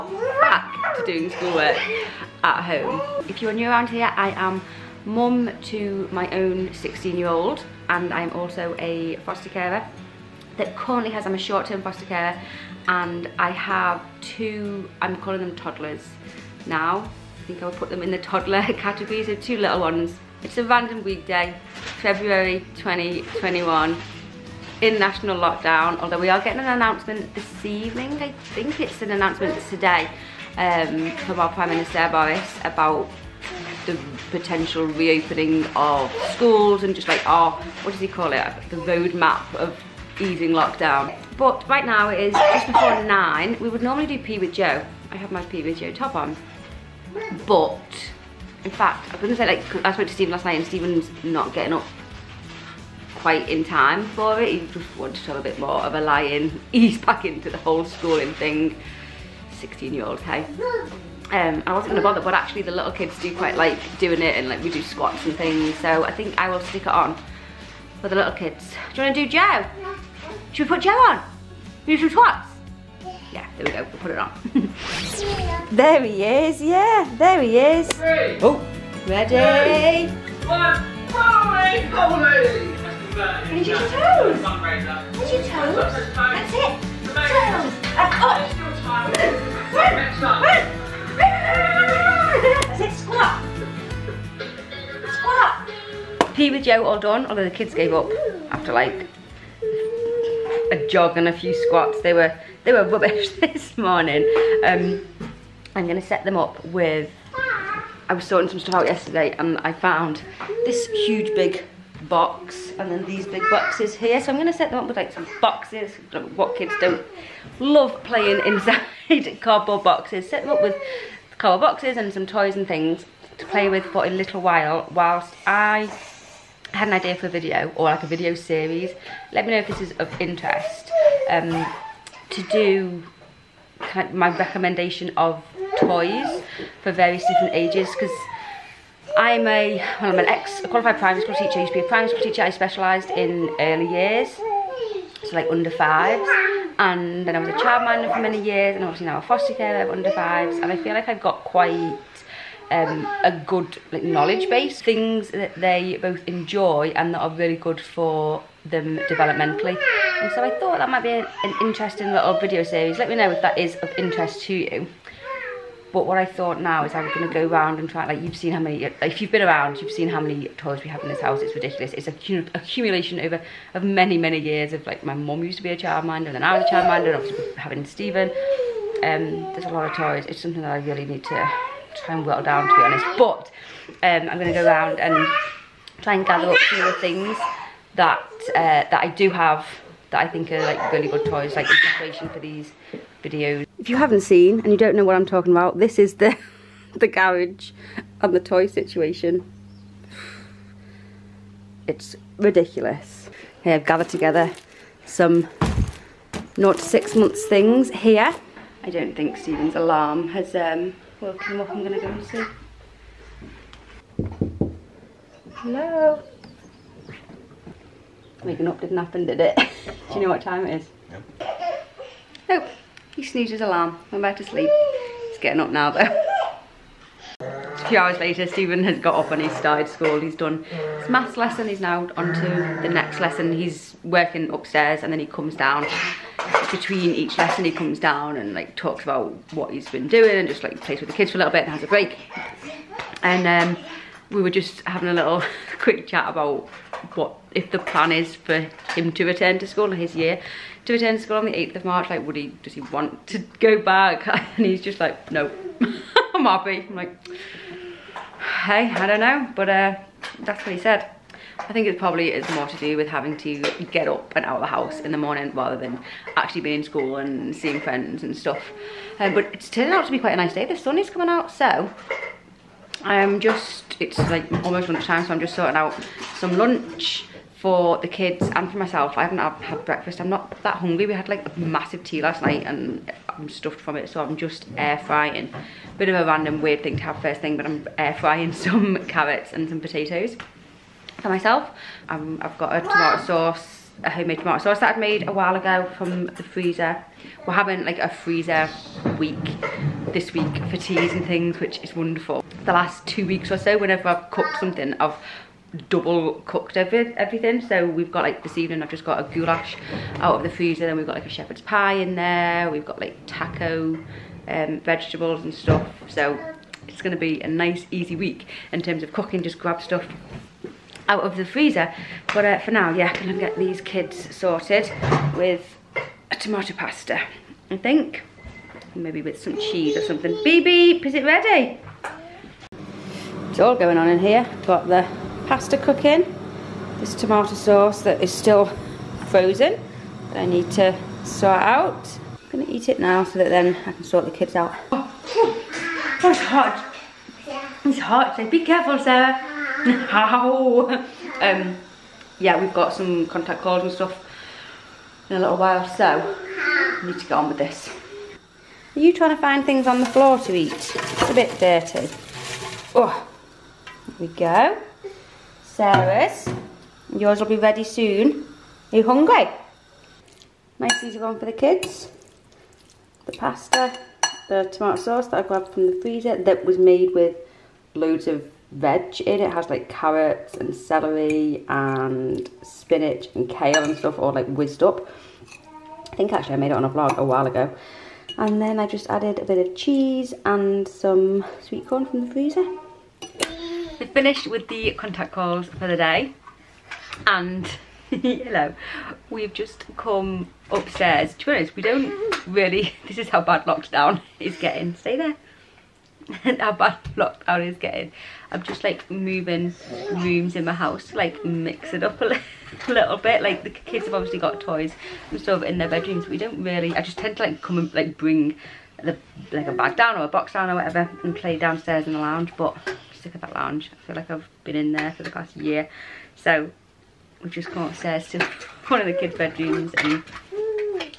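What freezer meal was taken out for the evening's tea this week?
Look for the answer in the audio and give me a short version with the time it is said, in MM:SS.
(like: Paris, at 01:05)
goulash, at 05:09.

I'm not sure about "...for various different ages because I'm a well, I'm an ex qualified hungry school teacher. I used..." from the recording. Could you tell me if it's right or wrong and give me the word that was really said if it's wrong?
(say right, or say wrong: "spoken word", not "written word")
wrong: "primary", not "hungry".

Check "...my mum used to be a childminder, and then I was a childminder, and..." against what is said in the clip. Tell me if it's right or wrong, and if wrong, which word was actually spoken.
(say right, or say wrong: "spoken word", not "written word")
right.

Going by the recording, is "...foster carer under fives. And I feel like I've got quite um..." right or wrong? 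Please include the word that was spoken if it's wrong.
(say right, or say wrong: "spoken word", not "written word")
right.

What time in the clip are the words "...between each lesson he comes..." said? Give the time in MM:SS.
03:56.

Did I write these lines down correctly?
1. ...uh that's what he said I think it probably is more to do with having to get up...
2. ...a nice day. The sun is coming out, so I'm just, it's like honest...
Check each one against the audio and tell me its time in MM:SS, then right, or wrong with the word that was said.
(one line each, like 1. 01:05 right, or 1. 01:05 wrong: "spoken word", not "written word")
1. 04:19 right
2. 04:30 wrong: "almost", not "honest".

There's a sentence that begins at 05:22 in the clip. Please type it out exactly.
But uh, for now, yeah, I'm going to get these kids sorted with a tomato pasta, I think.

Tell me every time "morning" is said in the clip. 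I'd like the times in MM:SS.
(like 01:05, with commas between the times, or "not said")
01:43, 04:25.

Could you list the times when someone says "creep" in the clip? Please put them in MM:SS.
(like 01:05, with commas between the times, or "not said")
not said.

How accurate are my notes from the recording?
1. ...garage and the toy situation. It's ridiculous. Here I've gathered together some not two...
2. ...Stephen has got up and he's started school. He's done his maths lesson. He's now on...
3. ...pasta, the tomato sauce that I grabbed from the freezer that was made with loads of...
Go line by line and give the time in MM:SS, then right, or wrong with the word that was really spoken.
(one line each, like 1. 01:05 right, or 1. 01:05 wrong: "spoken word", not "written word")
1. 03:17 wrong: "six", not "two"
2. 03:48 right
3. 06:13 right.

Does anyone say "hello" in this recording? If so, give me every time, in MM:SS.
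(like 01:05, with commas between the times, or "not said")
03:35, 06:38.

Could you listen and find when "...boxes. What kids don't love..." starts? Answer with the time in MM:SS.
01:55.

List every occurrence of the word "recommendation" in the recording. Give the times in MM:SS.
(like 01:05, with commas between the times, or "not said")
02:14.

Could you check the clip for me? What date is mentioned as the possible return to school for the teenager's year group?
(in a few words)
8th of March.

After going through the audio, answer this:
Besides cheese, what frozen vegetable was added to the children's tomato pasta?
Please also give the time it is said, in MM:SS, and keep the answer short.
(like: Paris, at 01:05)
sweet corn, at 06:31.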